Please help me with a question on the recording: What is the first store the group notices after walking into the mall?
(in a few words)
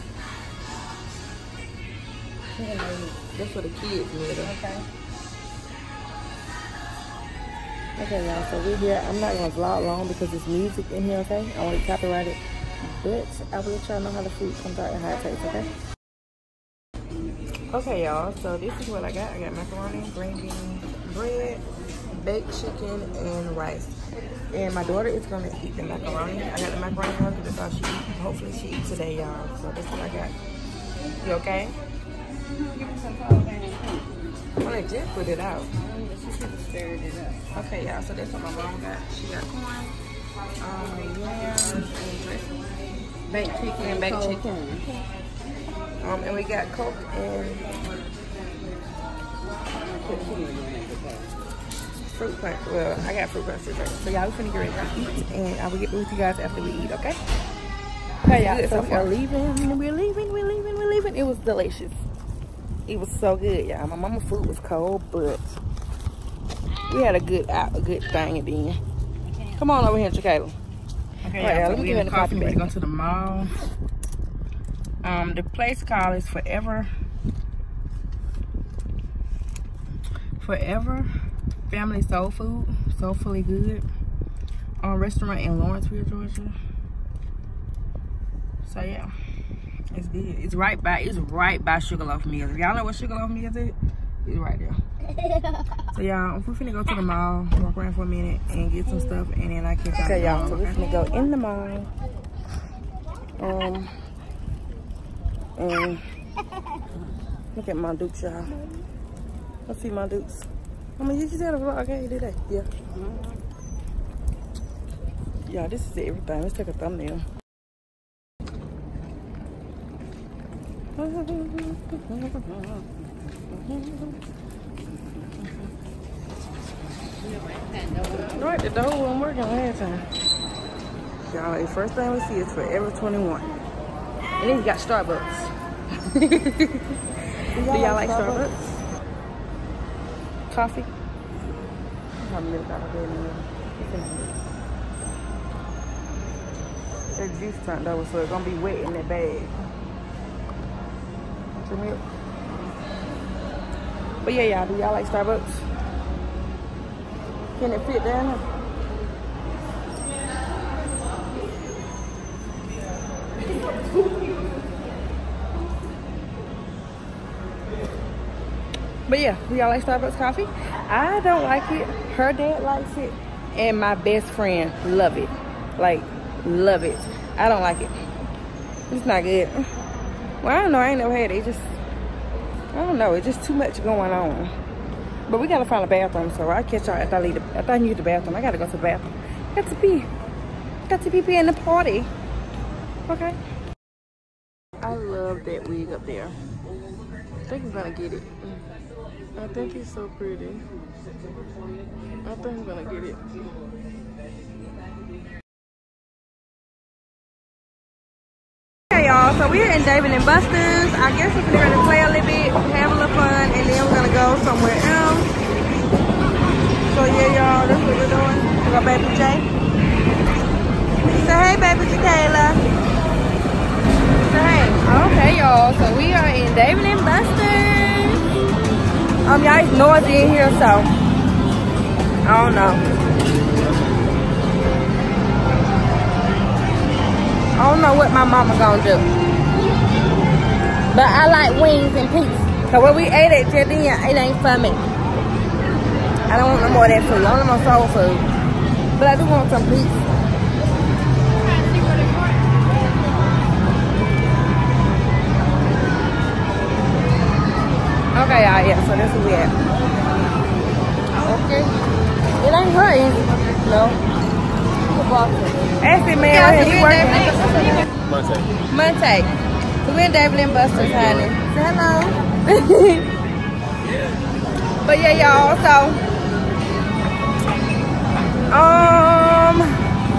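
Forever 21.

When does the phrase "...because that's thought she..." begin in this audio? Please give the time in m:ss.
0:27.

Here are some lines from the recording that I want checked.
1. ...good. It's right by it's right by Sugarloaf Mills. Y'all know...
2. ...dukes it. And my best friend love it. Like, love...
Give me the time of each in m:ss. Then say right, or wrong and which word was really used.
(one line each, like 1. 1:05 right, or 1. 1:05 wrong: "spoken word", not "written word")
1. 1:30 right
2. 2:52 wrong: "likes", not "dukes".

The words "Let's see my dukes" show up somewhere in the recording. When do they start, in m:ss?
1:49.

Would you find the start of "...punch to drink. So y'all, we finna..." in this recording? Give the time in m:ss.
0:53.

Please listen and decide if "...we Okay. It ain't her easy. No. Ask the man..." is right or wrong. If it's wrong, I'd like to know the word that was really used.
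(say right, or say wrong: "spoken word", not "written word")
right.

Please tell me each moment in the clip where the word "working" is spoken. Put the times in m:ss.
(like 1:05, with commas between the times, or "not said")
2:09, 4:26.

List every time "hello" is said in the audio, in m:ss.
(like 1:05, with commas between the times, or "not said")
4:31.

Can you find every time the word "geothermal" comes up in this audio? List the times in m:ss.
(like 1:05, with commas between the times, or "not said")
not said.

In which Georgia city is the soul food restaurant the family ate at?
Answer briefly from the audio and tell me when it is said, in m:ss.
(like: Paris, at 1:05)
Lawrenceville, at 1:25.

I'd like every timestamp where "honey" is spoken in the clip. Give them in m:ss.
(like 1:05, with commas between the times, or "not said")
4:30.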